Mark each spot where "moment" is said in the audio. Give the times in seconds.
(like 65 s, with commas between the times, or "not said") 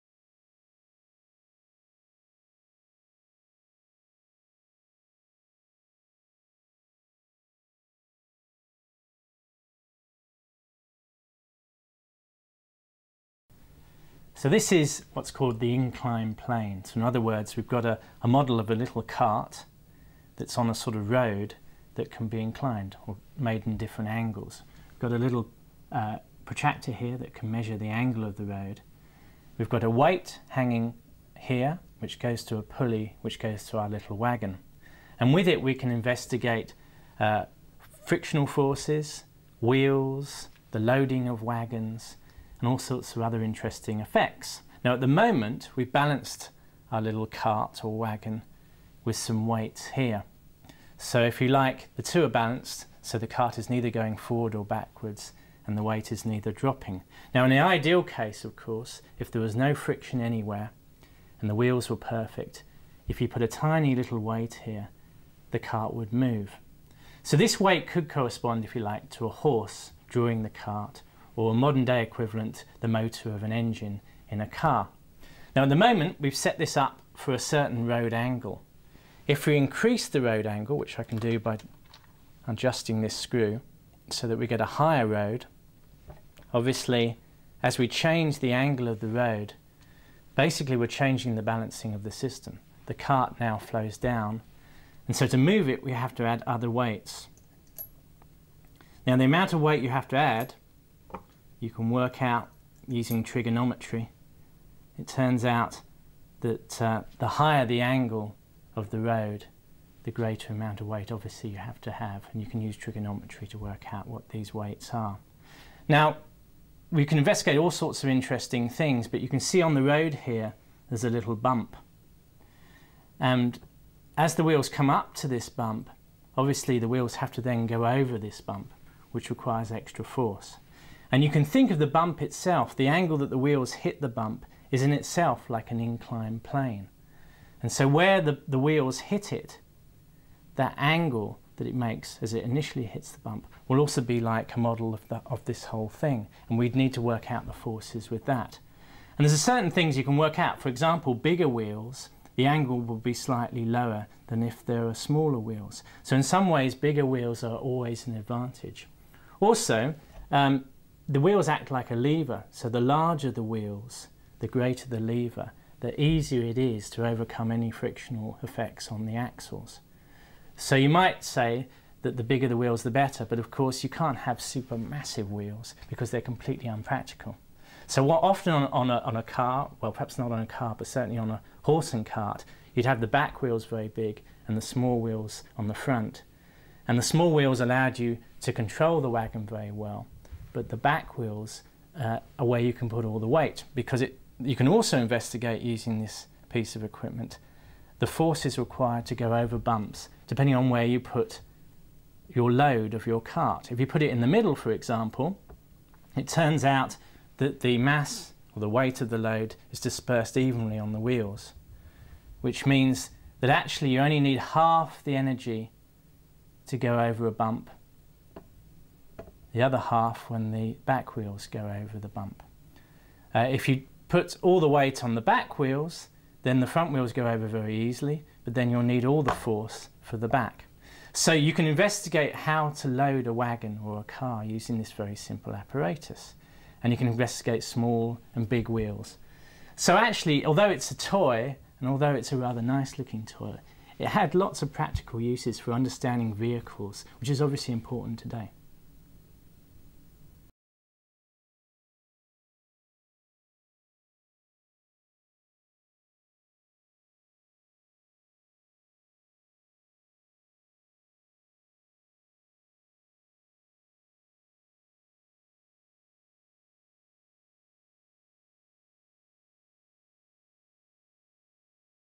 45 s, 75 s.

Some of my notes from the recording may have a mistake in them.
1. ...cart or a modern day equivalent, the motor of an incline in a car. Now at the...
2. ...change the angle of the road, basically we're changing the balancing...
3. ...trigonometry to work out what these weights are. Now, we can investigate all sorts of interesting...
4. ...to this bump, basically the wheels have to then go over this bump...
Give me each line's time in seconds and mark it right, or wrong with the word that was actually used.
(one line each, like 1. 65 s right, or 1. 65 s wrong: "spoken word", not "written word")
1. 70 s wrong: "engine", not "incline"
2. 87 s right
3. 112 s right
4. 125 s wrong: "obviously", not "basically".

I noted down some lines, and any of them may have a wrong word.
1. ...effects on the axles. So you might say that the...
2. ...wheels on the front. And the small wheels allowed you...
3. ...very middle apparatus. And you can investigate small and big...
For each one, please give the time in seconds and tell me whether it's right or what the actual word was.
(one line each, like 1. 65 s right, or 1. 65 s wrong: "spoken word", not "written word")
1. 168 s right
2. 185 s right
3. 234 s wrong: "simple", not "middle".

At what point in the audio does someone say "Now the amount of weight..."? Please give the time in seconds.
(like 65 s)
99 s.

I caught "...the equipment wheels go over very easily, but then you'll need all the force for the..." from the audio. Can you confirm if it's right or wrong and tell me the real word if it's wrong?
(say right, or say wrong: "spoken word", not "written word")
wrong: "front", not "equipment".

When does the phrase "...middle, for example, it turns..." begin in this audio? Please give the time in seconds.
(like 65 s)
204 s.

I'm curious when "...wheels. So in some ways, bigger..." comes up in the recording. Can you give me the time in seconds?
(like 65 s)
155 s.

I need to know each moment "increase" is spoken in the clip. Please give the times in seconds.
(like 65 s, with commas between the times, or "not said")
79 s.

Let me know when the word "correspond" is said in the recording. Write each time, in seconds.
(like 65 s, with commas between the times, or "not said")
68 s.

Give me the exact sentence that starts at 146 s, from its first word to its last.
And we'd need to work out the forces with that.